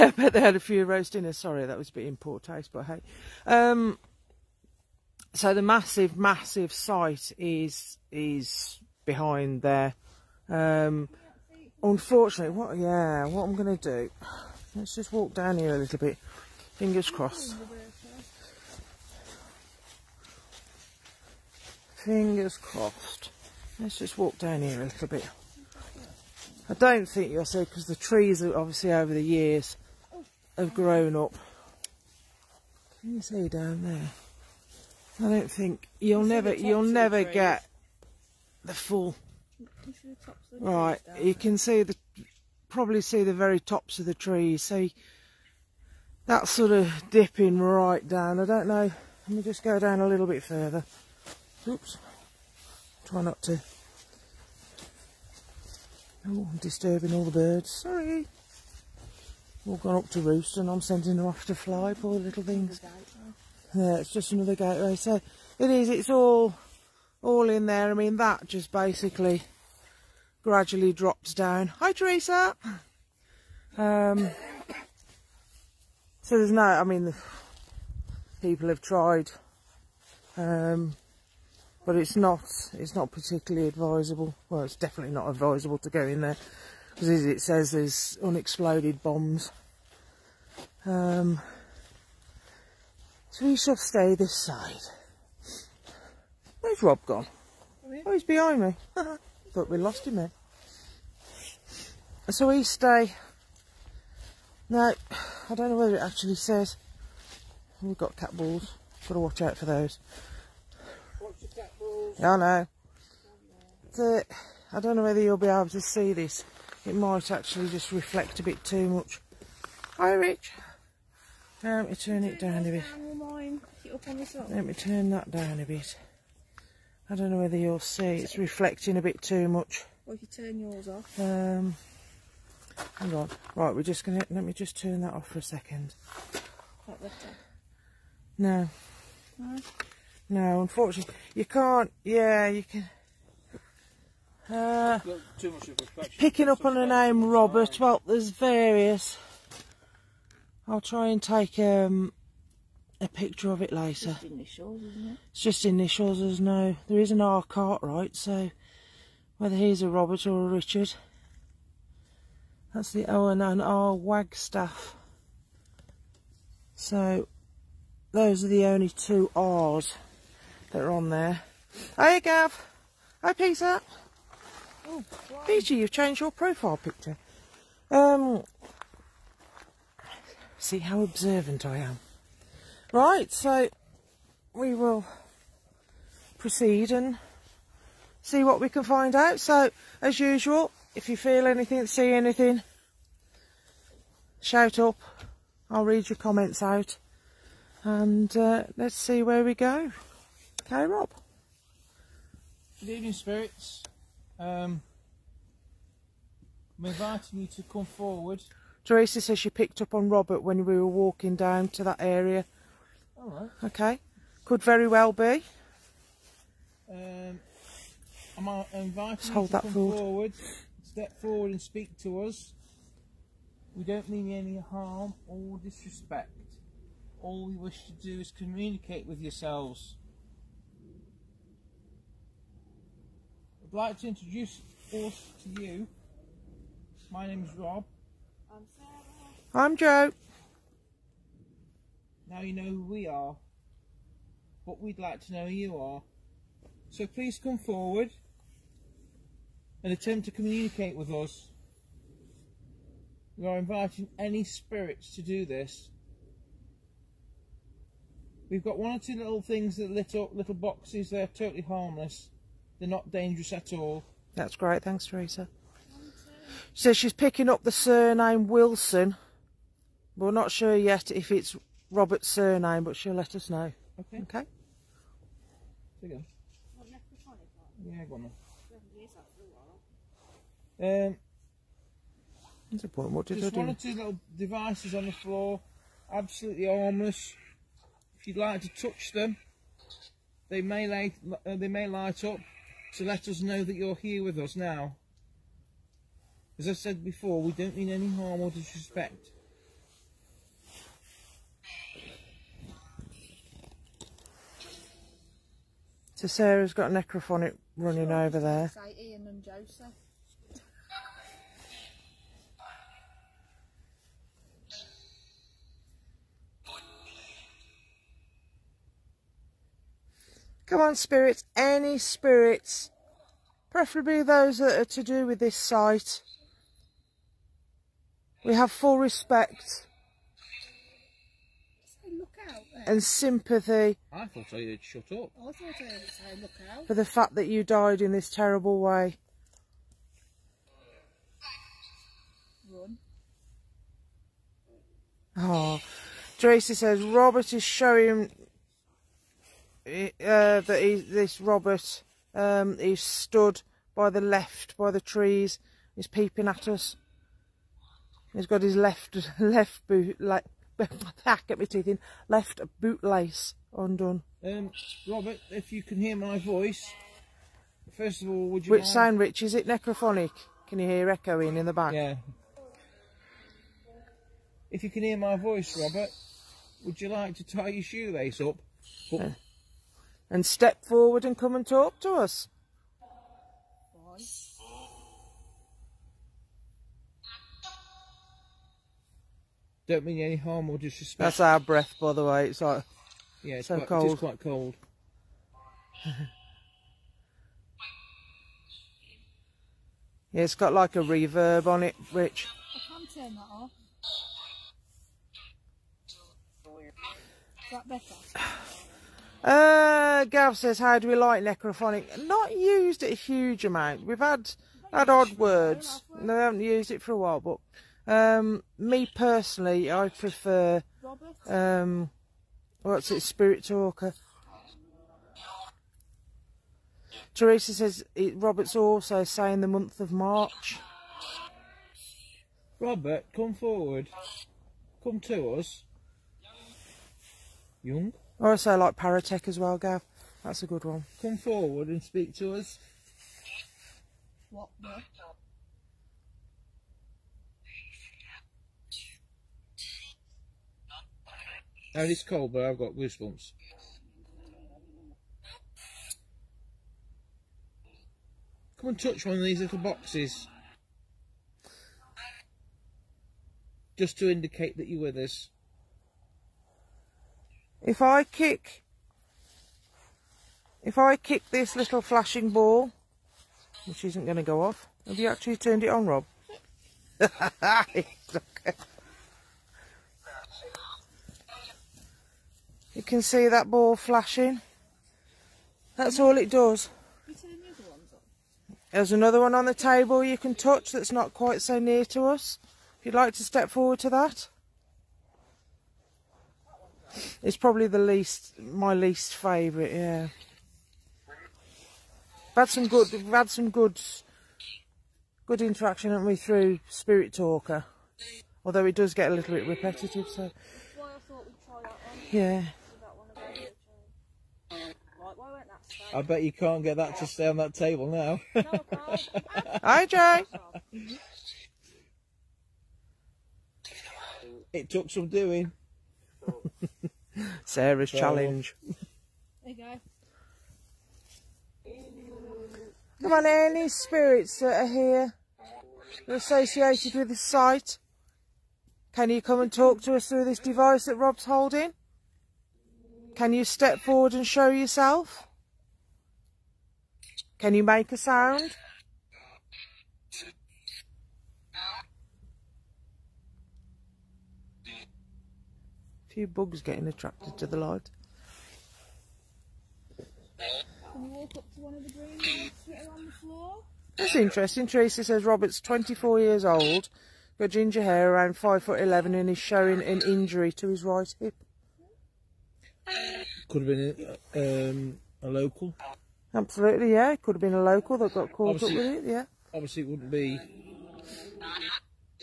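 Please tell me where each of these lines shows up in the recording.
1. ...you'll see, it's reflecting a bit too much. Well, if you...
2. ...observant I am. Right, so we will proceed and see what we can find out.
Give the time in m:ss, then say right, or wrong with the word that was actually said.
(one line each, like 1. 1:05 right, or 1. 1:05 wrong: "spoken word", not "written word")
1. 2:07 right
2. 3:01 right.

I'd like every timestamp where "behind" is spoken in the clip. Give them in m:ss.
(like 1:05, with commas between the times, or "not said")
0:09, 1:38.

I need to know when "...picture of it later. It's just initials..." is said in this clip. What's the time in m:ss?
2:33.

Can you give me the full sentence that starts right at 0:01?
Sorry, that was a bit in poor taste, but hey.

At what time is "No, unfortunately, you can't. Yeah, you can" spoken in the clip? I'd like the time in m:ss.
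2:20.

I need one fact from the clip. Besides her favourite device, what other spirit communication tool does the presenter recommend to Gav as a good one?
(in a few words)
Paratech.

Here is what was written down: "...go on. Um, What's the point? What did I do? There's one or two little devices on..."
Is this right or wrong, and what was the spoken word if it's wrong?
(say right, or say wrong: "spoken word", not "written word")
right.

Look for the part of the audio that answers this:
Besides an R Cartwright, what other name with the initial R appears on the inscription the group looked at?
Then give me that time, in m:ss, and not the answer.
2:43.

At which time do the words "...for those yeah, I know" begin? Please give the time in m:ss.
1:49.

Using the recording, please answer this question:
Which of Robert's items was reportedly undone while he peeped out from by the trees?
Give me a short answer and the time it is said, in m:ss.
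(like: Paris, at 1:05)
left boot lace, at 6:02.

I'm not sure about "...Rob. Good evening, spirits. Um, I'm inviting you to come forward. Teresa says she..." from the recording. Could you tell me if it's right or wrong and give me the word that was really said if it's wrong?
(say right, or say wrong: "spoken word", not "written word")
right.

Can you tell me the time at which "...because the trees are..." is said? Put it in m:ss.
0:27.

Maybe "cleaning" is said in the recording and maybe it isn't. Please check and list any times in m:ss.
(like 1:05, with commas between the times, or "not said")
not said.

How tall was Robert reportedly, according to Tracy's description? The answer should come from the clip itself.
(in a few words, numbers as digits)
5 foot 11.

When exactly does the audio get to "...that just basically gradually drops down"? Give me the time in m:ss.
1:08.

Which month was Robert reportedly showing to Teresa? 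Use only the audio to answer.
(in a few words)
March.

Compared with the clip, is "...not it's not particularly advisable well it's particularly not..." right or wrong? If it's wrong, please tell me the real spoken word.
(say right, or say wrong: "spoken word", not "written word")
wrong: "definitely", not "particularly".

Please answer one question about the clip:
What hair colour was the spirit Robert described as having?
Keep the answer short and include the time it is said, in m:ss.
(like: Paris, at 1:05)
ginger, at 9:27.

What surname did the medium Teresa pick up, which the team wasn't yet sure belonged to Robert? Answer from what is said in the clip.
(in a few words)
Wilson.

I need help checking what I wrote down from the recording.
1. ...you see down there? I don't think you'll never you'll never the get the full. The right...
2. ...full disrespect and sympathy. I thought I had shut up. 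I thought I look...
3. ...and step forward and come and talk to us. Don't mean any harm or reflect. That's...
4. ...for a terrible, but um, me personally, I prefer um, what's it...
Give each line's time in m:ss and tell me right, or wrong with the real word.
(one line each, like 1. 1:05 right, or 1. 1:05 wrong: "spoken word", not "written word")
1. 0:33 right
2. 5:28 wrong: "respect", not "disrespect"
3. 6:20 wrong: "disrespect", not "reflect"
4. 6:57 wrong: "while", not "terrible".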